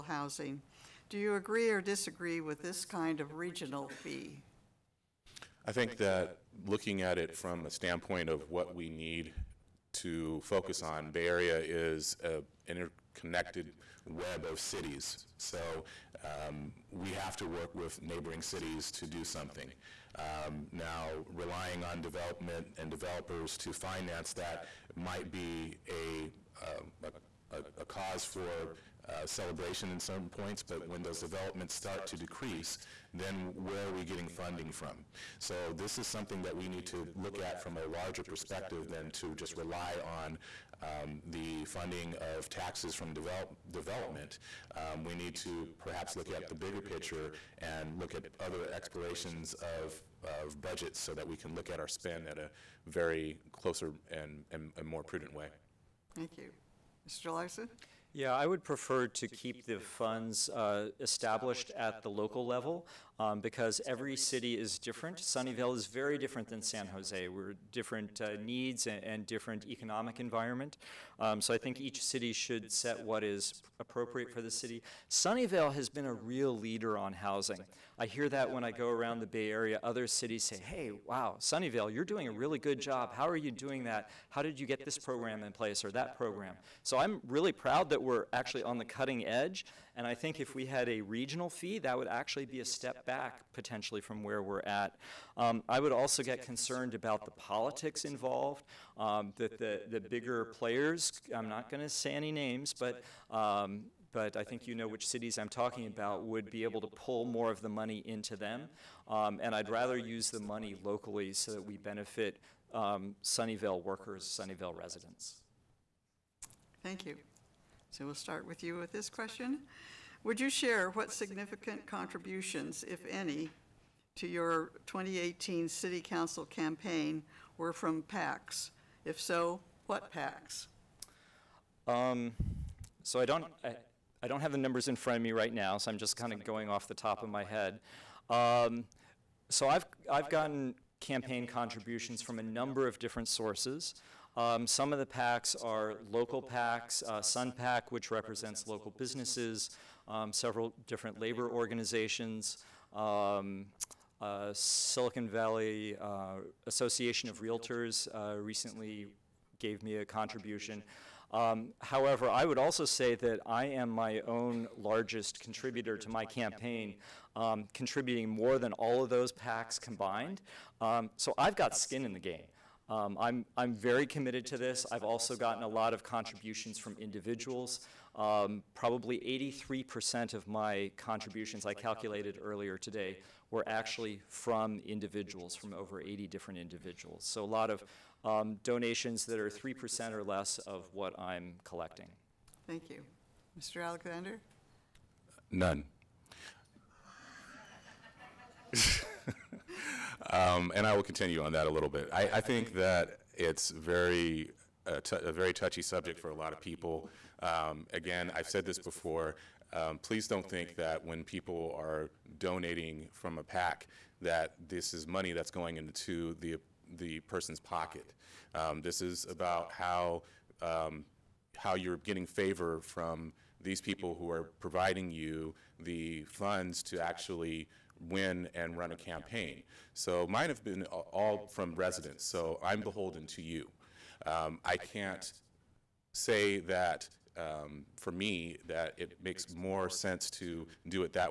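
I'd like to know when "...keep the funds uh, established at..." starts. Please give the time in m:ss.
0:59.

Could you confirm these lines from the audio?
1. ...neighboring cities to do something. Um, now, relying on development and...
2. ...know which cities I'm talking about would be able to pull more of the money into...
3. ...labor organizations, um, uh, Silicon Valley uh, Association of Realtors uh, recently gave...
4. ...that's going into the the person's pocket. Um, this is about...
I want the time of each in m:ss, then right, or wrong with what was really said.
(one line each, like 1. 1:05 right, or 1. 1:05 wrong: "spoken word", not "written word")
1. 0:18 right
2. 1:44 right
3. 2:31 right
4. 3:35 right.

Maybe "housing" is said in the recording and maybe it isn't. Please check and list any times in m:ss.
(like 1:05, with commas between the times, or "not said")
0:00, 1:17.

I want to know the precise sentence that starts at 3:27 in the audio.
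Um, again, I've said this before.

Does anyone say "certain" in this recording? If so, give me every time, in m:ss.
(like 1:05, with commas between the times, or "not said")
0:29.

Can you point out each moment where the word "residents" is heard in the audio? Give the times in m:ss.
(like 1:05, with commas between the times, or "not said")
1:54, 3:51.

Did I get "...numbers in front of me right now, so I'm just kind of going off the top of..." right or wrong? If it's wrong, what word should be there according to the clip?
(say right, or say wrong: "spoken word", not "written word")
right.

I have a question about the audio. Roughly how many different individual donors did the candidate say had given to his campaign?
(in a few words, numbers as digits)
Over 80.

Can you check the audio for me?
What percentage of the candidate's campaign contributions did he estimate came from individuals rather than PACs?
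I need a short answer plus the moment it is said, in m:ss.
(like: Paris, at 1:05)
83%, at 2:59.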